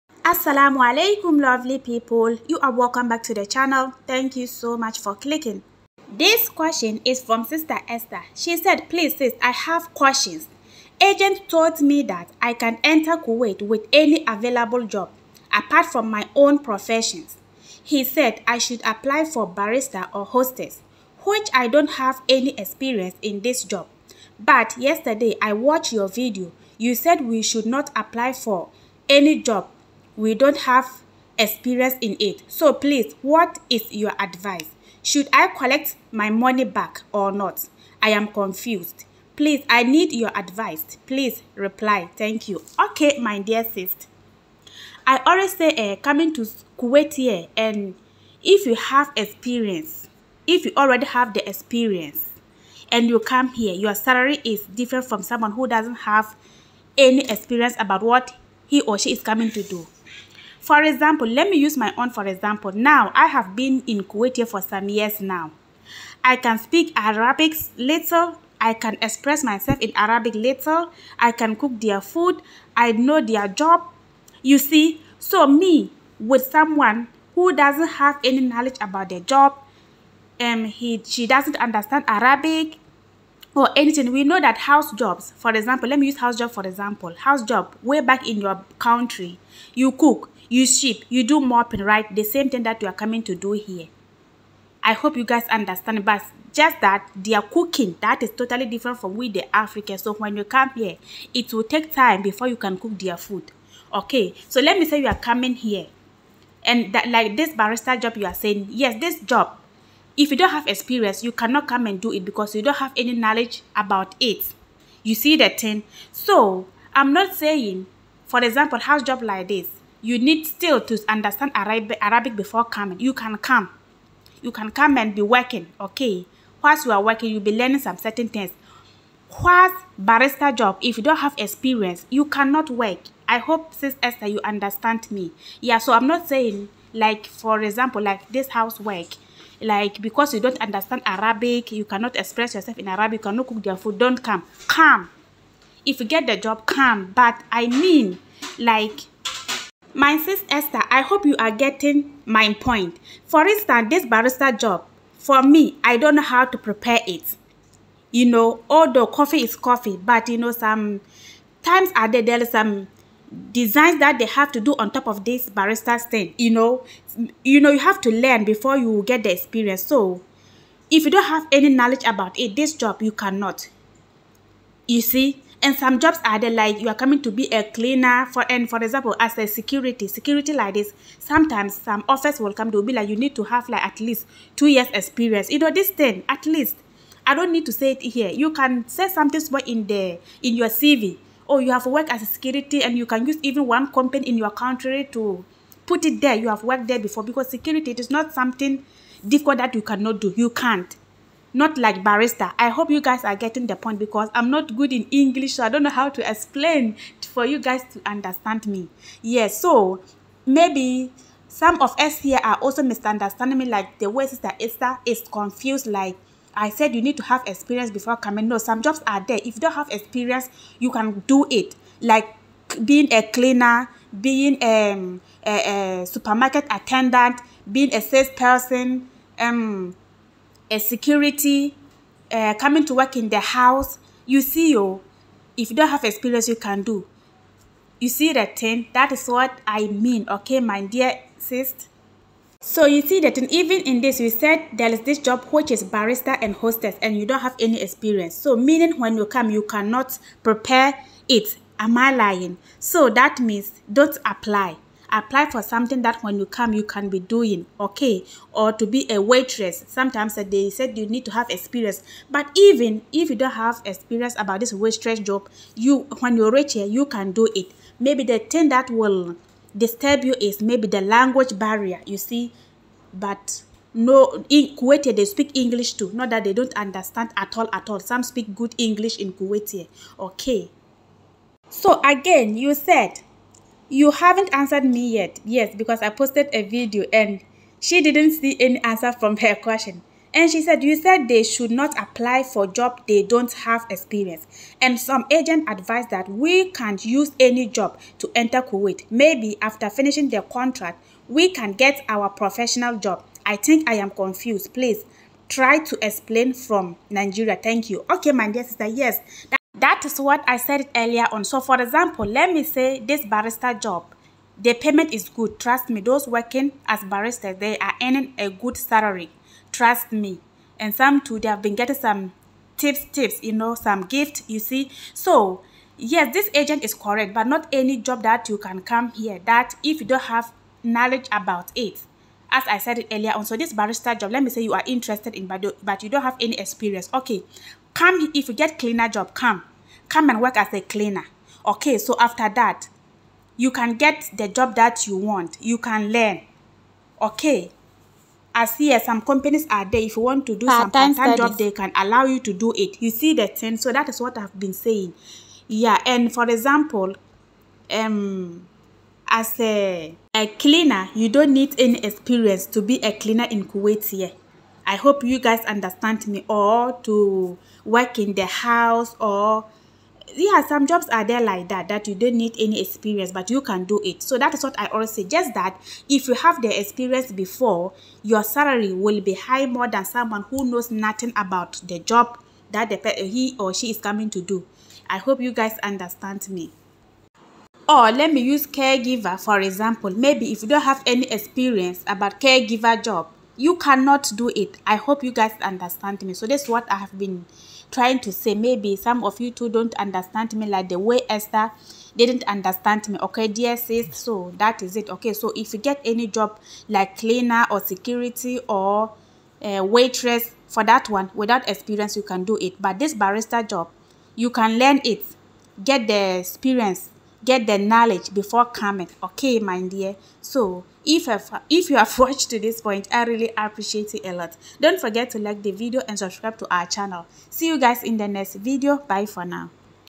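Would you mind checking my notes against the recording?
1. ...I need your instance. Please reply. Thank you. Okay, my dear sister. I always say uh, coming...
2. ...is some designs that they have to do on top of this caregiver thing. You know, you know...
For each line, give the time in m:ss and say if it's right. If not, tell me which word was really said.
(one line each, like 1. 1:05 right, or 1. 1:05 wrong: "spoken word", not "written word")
1. 0:39 wrong: "advice", not "instance"
2. 2:42 wrong: "barrister", not "caregiver".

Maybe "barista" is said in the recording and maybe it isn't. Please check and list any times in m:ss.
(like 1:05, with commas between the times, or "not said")
2:10, 3:22, 6:53.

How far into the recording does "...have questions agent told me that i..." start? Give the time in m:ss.
0:09.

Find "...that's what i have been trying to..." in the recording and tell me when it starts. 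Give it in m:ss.
6:36.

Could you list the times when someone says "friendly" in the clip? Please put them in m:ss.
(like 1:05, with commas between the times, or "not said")
not said.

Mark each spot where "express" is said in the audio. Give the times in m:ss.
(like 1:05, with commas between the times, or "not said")
1:09, 2:22.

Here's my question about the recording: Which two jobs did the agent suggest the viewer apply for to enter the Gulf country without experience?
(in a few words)
barrister or hostess.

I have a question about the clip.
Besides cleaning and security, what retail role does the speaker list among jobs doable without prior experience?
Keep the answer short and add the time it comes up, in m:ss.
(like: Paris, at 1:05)
supermarket attendant, at 3:46.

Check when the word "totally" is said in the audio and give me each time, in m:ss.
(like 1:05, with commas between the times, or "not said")
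1:38.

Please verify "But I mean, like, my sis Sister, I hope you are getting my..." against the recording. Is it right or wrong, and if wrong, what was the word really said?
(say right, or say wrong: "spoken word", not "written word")
wrong: "Esther", not "Sister".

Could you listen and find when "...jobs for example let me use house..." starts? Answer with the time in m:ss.
1:24.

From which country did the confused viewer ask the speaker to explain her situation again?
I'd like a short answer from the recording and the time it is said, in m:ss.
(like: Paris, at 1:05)
Nigeria, at 5:07.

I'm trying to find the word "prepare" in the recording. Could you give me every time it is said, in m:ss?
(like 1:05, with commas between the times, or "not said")
2:36, 4:10.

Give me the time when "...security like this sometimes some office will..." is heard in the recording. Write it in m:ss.
3:00.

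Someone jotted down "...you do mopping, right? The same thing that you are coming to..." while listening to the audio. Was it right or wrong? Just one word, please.
right.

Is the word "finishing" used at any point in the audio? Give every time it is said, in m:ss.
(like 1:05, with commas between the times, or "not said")
4:59.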